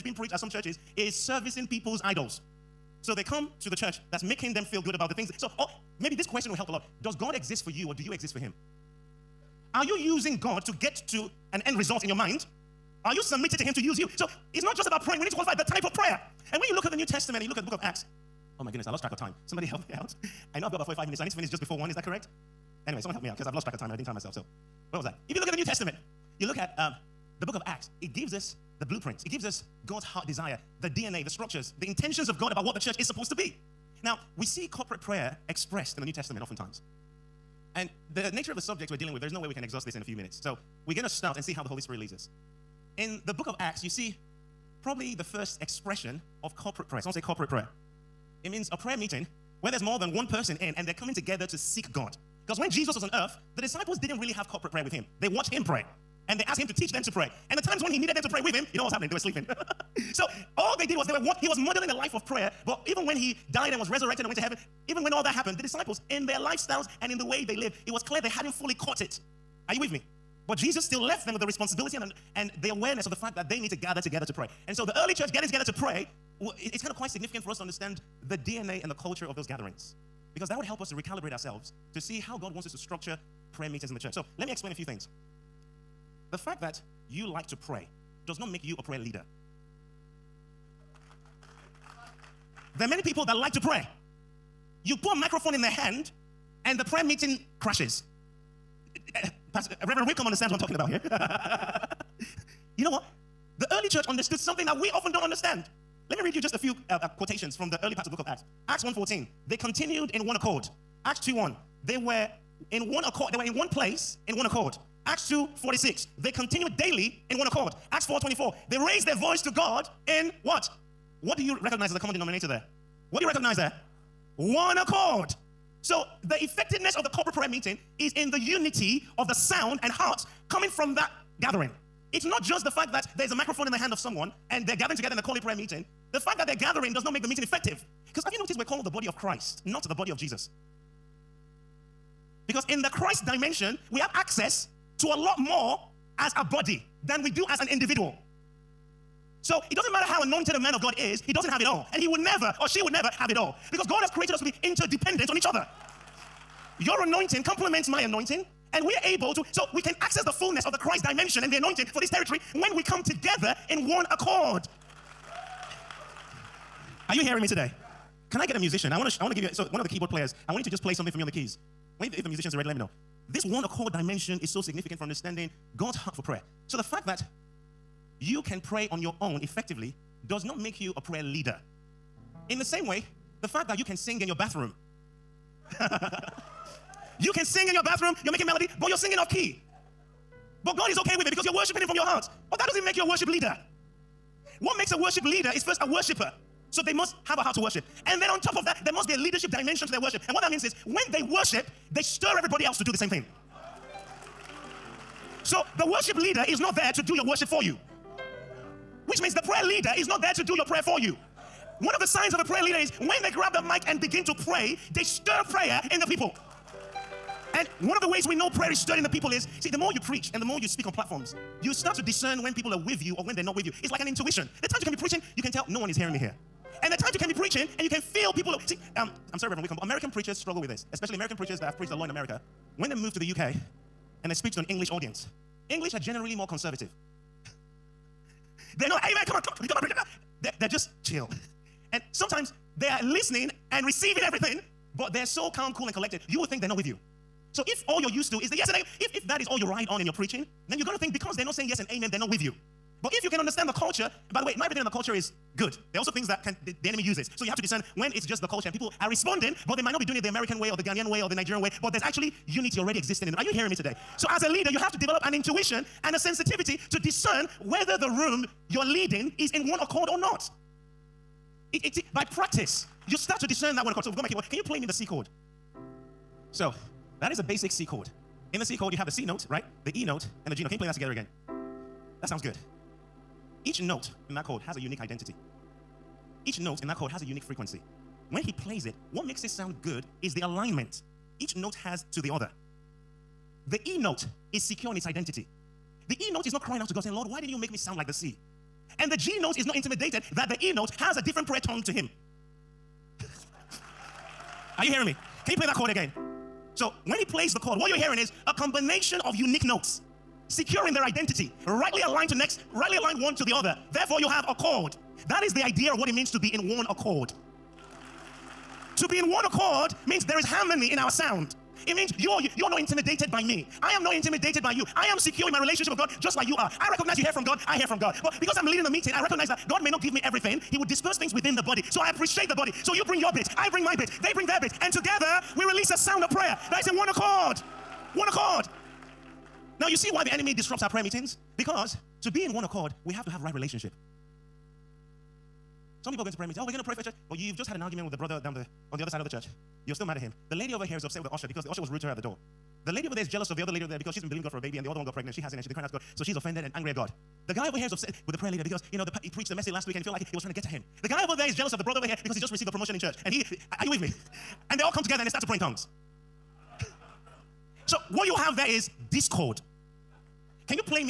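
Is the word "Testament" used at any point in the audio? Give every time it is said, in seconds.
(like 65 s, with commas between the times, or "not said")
17 s, 25 s, 36 s.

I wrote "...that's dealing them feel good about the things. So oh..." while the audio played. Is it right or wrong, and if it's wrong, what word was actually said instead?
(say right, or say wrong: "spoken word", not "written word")
wrong: "making", not "dealing".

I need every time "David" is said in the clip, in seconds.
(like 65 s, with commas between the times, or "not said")
not said.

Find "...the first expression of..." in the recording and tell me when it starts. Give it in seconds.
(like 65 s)
45 s.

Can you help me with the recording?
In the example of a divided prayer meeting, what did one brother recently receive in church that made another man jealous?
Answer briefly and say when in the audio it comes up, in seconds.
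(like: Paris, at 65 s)
A promotion, at 362 s.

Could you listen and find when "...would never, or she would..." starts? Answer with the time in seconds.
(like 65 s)
152 s.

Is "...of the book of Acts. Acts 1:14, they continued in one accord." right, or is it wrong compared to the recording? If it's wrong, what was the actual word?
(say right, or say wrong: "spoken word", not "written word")
right.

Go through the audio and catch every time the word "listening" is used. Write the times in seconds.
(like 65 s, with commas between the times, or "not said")
243 s.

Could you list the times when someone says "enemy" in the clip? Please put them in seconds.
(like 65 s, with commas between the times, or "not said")
256 s, 340 s.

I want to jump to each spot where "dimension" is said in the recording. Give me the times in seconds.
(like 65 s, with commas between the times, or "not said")
143 s, 161 s, 173 s, 199 s.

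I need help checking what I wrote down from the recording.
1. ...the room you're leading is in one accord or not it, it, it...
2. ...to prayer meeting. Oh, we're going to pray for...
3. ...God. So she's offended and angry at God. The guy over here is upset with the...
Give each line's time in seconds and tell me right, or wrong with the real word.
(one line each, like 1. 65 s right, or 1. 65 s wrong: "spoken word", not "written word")
1. 267 s right
2. 346 s right
3. 355 s right.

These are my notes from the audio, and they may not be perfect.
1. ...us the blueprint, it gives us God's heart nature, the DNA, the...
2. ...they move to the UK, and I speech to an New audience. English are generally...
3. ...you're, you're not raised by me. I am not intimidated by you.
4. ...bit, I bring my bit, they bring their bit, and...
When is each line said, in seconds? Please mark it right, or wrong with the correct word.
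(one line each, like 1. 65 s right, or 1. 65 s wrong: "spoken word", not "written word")
1. 28 s wrong: "desire", not "nature"
2. 232 s wrong: "English", not "New"
3. 322 s wrong: "intimidated", not "raised"
4. 333 s right.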